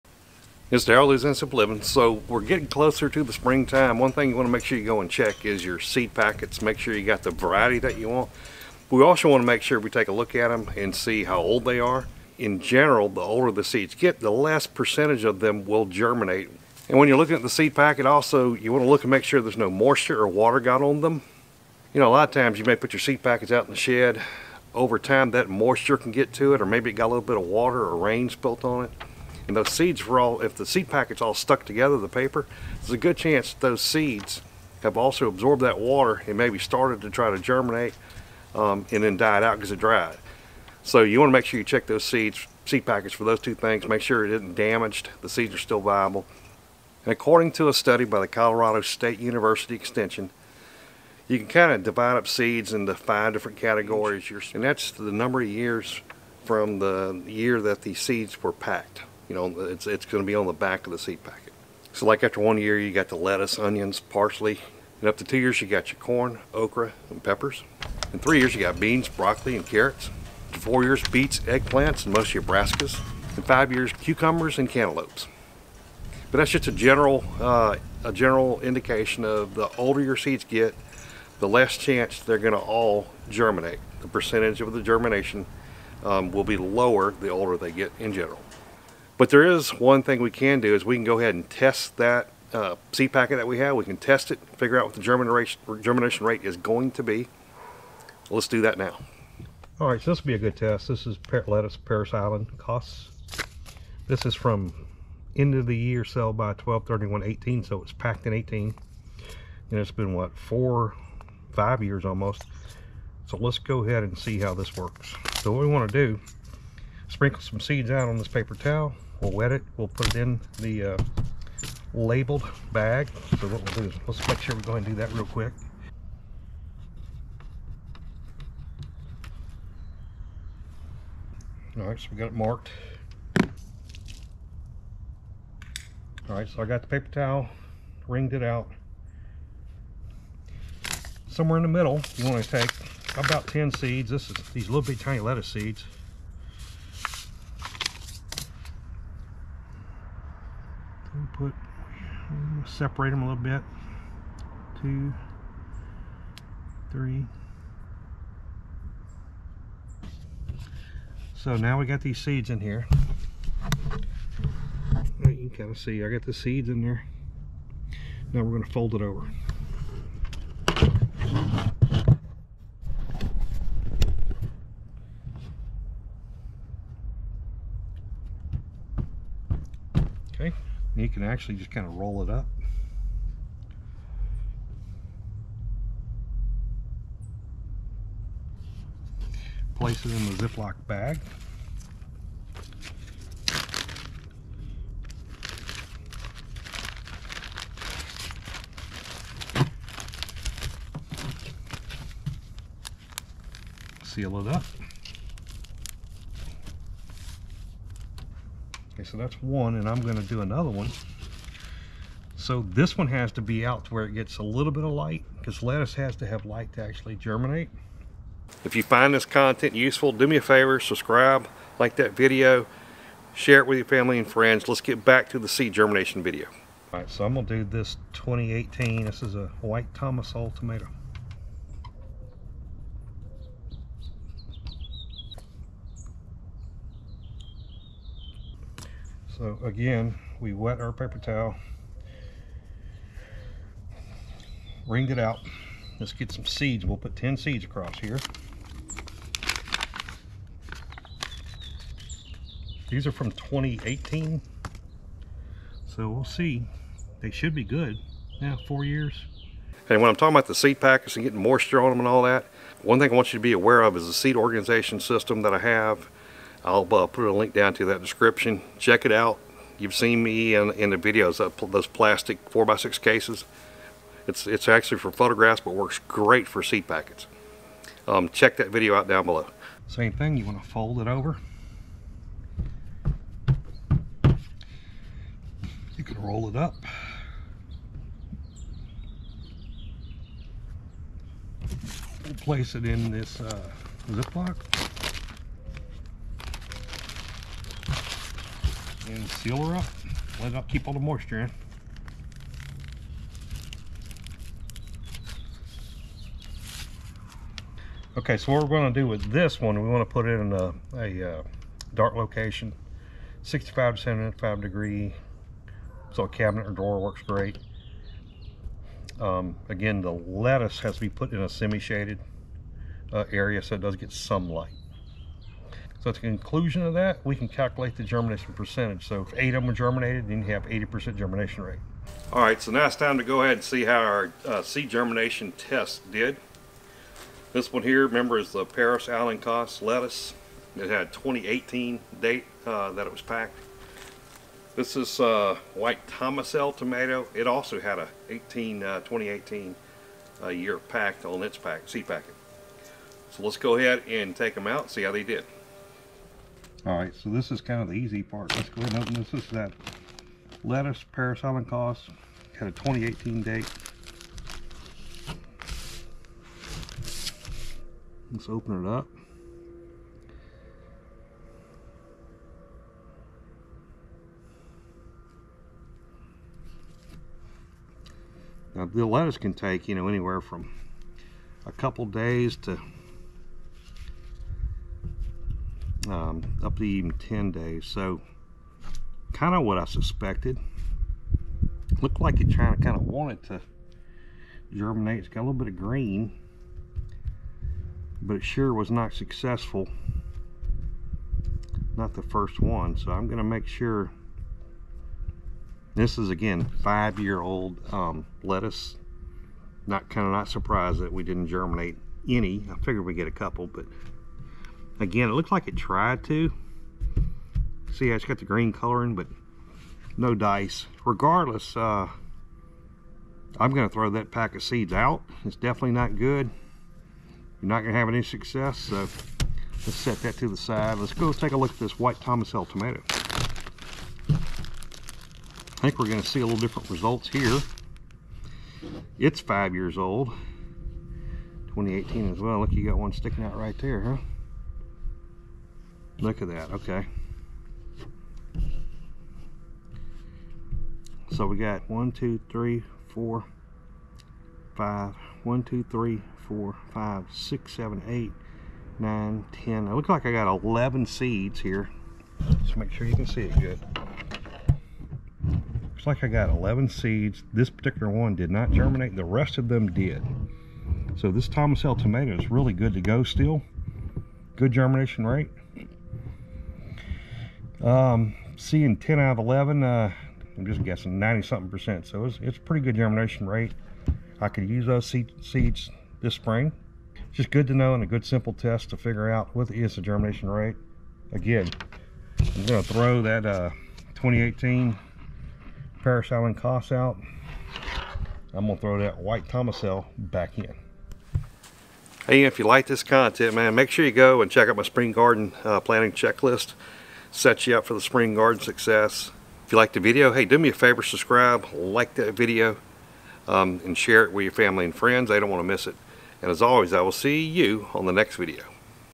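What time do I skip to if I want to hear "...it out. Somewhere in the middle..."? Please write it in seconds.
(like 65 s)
138 s.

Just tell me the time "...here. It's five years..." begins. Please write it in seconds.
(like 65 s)
437 s.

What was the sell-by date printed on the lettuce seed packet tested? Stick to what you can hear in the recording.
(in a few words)
12-31-18.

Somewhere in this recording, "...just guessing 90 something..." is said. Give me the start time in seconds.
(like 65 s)
480 s.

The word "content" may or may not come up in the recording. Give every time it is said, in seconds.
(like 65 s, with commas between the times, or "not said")
219 s, 503 s.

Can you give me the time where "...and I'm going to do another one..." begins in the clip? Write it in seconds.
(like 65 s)
209 s.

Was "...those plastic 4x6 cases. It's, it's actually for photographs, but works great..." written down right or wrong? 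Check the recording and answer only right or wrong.
right.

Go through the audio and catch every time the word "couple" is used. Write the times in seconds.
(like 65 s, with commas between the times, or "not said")
381 s, 413 s.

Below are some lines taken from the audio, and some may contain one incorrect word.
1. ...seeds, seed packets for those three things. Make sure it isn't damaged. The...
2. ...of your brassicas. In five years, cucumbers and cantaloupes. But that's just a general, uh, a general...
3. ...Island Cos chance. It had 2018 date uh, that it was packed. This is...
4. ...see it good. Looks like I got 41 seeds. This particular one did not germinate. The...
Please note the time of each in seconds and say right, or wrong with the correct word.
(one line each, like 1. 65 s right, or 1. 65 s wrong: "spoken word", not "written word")
1. 42 s wrong: "two", not "three"
2. 72 s right
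3. 339 s wrong: "lettuce", not "chance"
4. 463 s wrong: "11", not "41".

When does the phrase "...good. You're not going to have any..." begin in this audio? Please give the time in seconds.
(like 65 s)
426 s.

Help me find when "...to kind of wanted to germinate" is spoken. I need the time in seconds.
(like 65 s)
392 s.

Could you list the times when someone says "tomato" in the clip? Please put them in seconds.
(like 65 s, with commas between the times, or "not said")
230 s, 346 s, 432 s, 471 s.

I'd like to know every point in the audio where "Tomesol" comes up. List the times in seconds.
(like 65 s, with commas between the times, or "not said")
229 s, 346 s, 432 s, 471 s, 499 s.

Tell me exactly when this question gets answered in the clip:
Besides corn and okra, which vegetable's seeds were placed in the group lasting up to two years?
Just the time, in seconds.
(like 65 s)
67 s.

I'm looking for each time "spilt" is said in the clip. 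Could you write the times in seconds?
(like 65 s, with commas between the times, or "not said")
28 s.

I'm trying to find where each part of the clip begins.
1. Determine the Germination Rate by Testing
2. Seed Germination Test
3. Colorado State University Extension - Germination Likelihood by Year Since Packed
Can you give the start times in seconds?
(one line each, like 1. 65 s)
1. 332 s
2. 89 s
3. 50 s.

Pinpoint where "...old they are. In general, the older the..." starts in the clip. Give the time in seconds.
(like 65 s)
11 s.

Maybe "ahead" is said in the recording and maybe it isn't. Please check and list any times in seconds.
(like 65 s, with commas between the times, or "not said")
91 s, 113 s, 124 s, 333 s, 353 s, 358 s.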